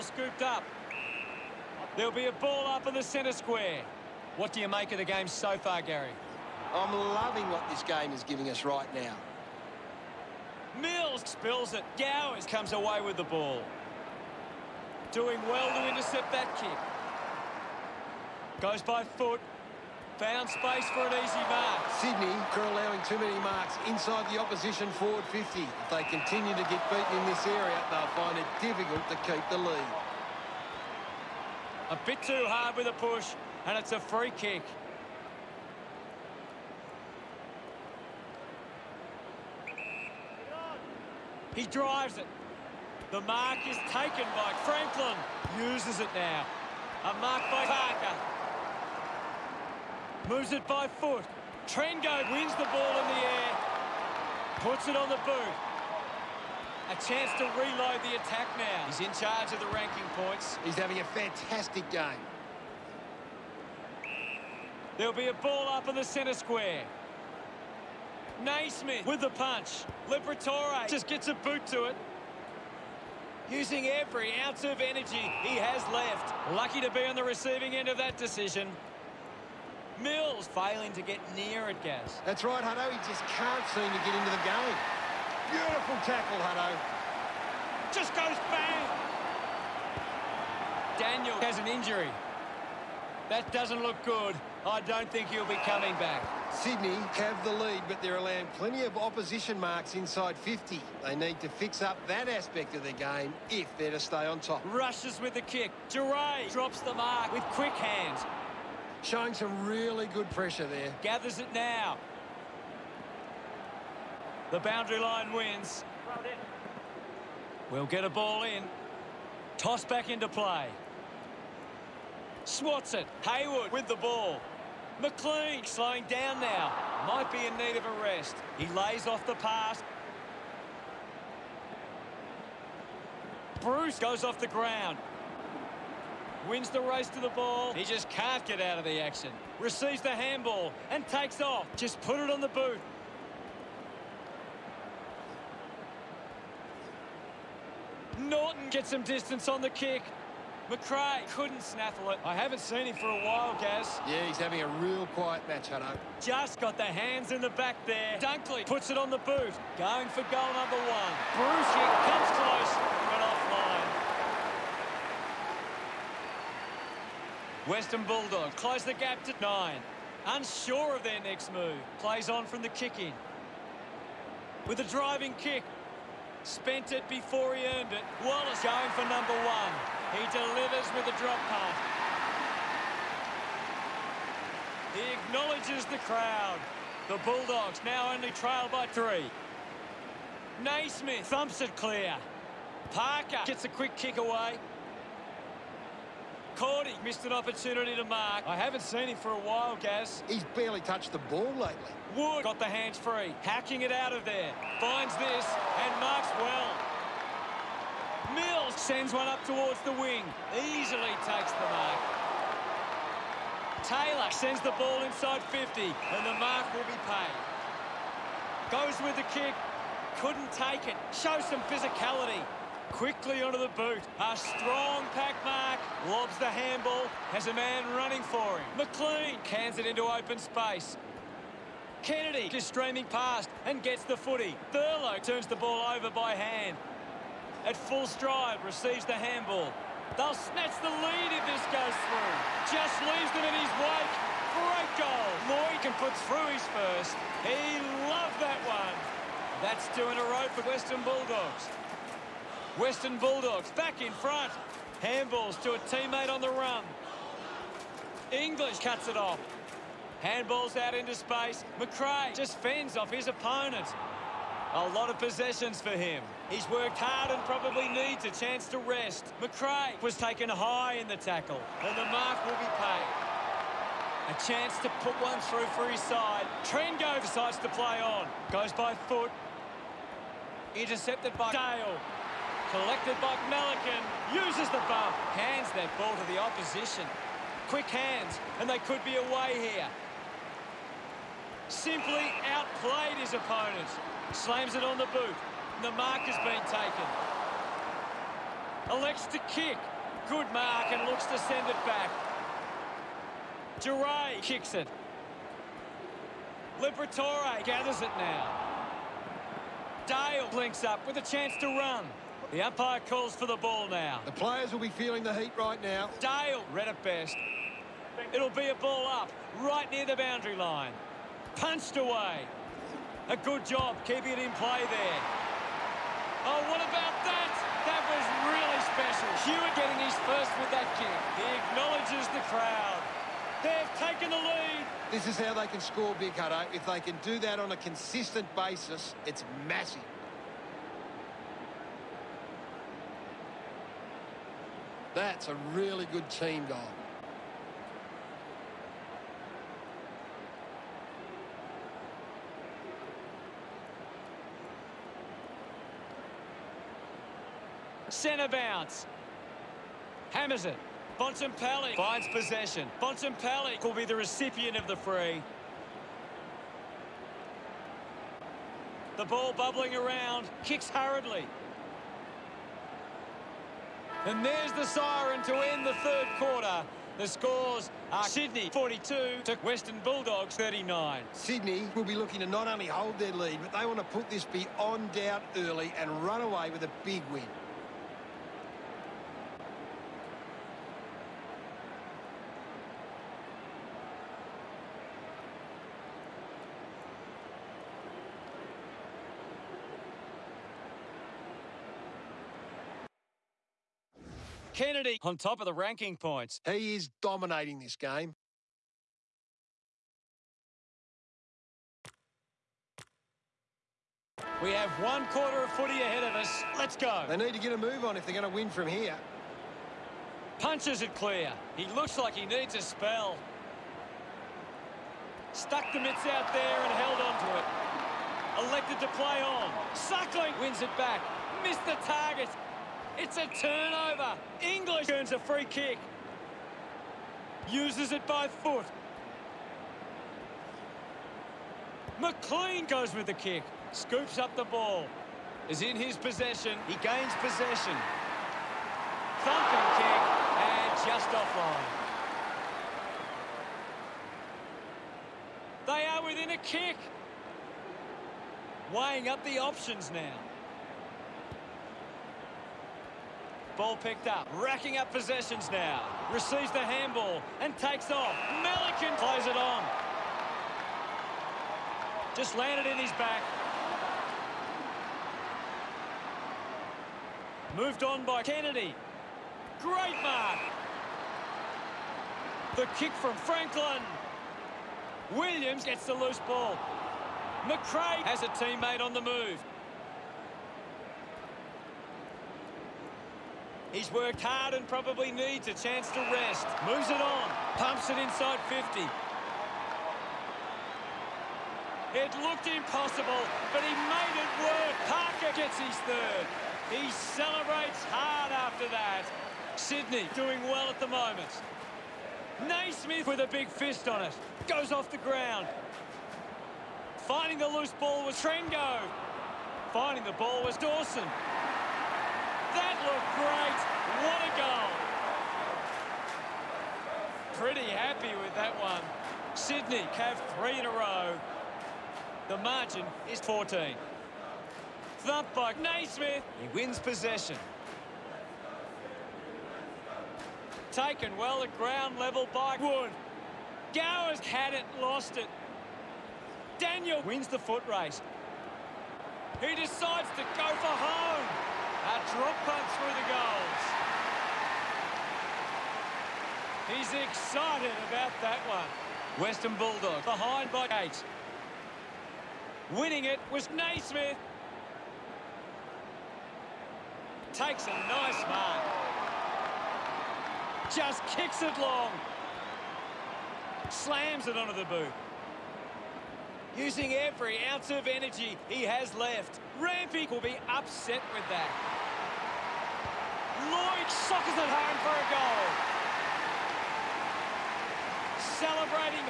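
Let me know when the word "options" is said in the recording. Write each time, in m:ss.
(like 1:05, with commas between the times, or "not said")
7:39.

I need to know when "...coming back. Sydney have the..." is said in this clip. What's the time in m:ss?
1:35.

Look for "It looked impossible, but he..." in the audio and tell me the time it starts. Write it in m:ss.
8:22.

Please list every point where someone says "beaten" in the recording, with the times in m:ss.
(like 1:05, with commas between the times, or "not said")
0:26.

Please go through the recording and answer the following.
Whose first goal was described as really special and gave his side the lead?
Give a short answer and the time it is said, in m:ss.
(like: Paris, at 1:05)
Hewett, at 5:29.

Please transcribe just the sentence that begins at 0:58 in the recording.
He's in charge of the ranking points.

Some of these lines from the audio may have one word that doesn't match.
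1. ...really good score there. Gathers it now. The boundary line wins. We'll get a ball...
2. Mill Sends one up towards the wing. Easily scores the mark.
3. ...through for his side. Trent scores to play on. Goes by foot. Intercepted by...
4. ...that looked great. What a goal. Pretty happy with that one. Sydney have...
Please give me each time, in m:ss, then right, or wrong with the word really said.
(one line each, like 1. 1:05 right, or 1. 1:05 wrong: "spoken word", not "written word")
1. 1:49 wrong: "pressure", not "score"
2. 3:28 wrong: "takes", not "scores"
3. 4:35 wrong: "decides", not "scores"
4. 8:42 right.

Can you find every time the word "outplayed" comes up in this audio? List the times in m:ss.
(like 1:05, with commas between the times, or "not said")
4:52.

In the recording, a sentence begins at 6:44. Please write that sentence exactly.
Kennedy on top of the ranking points.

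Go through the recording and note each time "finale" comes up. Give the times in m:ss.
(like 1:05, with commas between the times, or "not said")
not said.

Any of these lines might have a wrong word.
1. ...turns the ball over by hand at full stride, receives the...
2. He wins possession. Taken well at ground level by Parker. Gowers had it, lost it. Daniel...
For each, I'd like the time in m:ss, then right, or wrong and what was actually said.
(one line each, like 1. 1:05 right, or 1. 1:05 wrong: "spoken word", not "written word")
1. 3:55 right
2. 8:56 wrong: "Wood", not "Parker".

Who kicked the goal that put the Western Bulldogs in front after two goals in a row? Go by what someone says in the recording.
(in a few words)
Moy.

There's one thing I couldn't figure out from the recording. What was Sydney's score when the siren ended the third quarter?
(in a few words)
42.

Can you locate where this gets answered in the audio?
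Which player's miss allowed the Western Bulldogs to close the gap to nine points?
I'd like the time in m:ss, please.
2:41.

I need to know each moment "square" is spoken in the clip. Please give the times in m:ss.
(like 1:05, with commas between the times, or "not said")
0:03, 1:06.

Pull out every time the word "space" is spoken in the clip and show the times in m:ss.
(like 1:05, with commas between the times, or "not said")
0:20, 3:50, 4:21.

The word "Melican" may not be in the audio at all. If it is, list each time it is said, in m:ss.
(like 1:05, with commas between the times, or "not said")
4:43, 7:48.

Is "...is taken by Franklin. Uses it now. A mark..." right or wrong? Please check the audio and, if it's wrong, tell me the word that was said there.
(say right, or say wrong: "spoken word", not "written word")
right.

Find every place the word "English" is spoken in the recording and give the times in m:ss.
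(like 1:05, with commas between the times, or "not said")
4:18, 7:14.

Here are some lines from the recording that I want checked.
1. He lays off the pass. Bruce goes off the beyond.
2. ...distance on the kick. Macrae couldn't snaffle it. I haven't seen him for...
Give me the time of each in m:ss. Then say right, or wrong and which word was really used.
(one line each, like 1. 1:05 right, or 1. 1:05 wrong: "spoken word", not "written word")
1. 2:08 wrong: "ground", not "beyond"
2. 2:29 right.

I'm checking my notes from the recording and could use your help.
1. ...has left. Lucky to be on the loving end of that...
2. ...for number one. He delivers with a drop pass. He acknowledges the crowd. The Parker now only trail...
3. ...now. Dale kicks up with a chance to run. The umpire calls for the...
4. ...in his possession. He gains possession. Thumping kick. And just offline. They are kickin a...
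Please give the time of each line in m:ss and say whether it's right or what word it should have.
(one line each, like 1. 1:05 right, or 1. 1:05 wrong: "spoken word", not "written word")
1. 1:15 wrong: "receiving", not "loving"
2. 2:58 wrong: "Bulldogs", not "Parker"
3. 5:08 wrong: "blinks", not "kicks"
4. 7:25 wrong: "within", not "kickin".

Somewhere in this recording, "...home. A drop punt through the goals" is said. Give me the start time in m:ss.
9:11.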